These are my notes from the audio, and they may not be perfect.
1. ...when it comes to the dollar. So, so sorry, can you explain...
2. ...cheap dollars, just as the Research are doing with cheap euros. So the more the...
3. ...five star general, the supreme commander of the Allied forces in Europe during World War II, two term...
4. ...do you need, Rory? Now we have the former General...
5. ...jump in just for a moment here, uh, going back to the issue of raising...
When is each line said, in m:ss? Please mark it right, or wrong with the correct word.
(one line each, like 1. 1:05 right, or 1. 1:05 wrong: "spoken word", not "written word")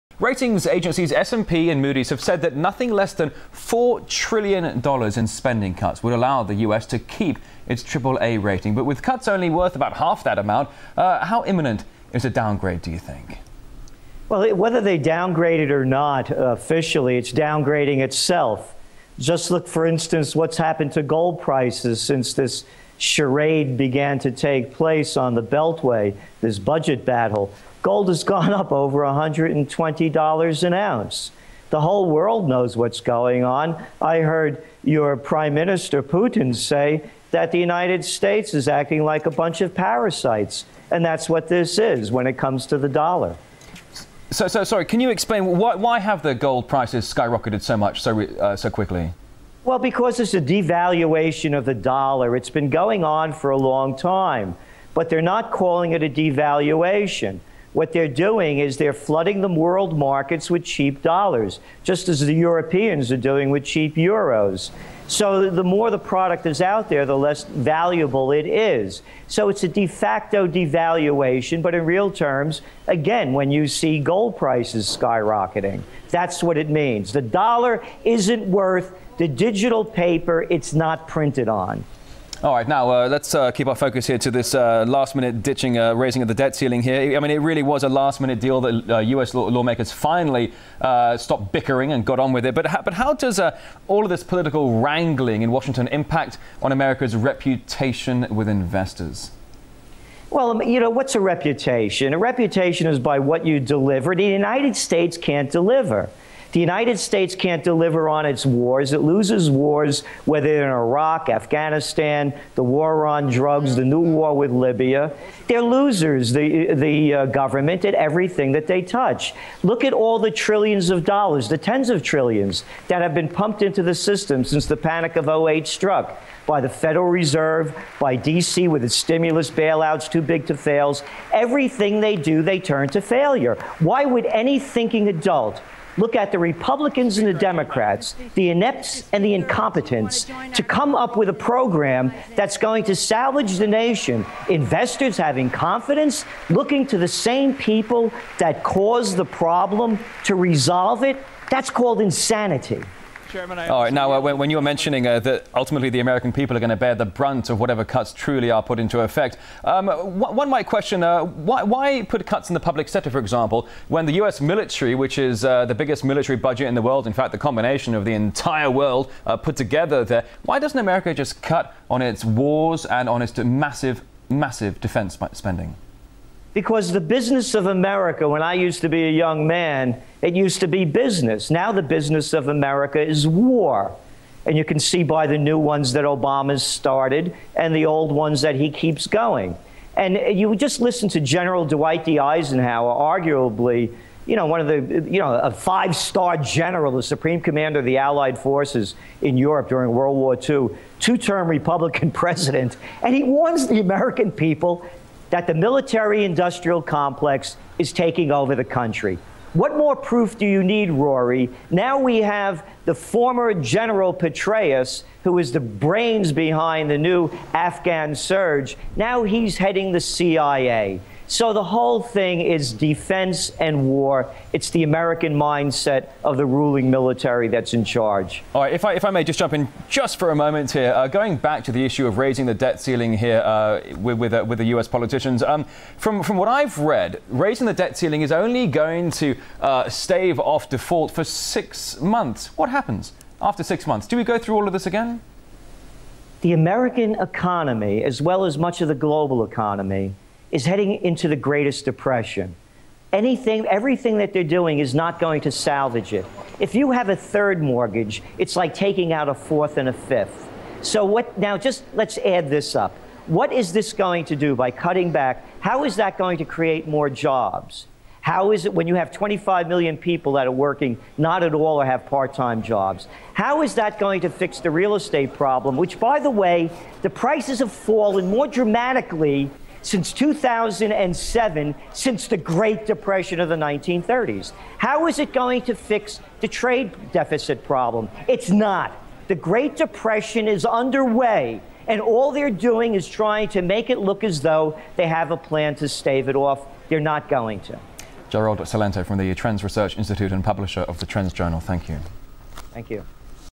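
1. 0:42 right
2. 1:00 wrong: "Europeans", not "Research"
3. 3:15 right
4. 3:30 right
5. 3:49 right.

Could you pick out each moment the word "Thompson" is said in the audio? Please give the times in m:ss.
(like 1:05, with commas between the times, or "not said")
not said.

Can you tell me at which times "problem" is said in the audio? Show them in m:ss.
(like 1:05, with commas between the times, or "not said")
2:29, 4:35, 4:47.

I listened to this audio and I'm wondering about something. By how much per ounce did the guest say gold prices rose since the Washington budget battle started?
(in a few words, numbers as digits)
over $120.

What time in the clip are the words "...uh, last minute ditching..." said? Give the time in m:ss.
1:24.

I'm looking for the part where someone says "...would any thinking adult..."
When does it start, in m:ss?
2:14.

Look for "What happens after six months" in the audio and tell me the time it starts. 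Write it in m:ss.
4:02.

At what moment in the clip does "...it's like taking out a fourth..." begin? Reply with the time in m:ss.
4:18.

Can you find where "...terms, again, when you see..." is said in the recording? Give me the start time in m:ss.
1:12.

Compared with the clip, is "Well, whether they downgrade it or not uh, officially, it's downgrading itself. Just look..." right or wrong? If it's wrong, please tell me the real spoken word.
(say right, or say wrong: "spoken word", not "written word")
right.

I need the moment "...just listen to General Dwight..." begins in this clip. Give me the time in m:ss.
3:10.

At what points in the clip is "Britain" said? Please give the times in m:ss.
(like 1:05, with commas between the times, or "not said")
not said.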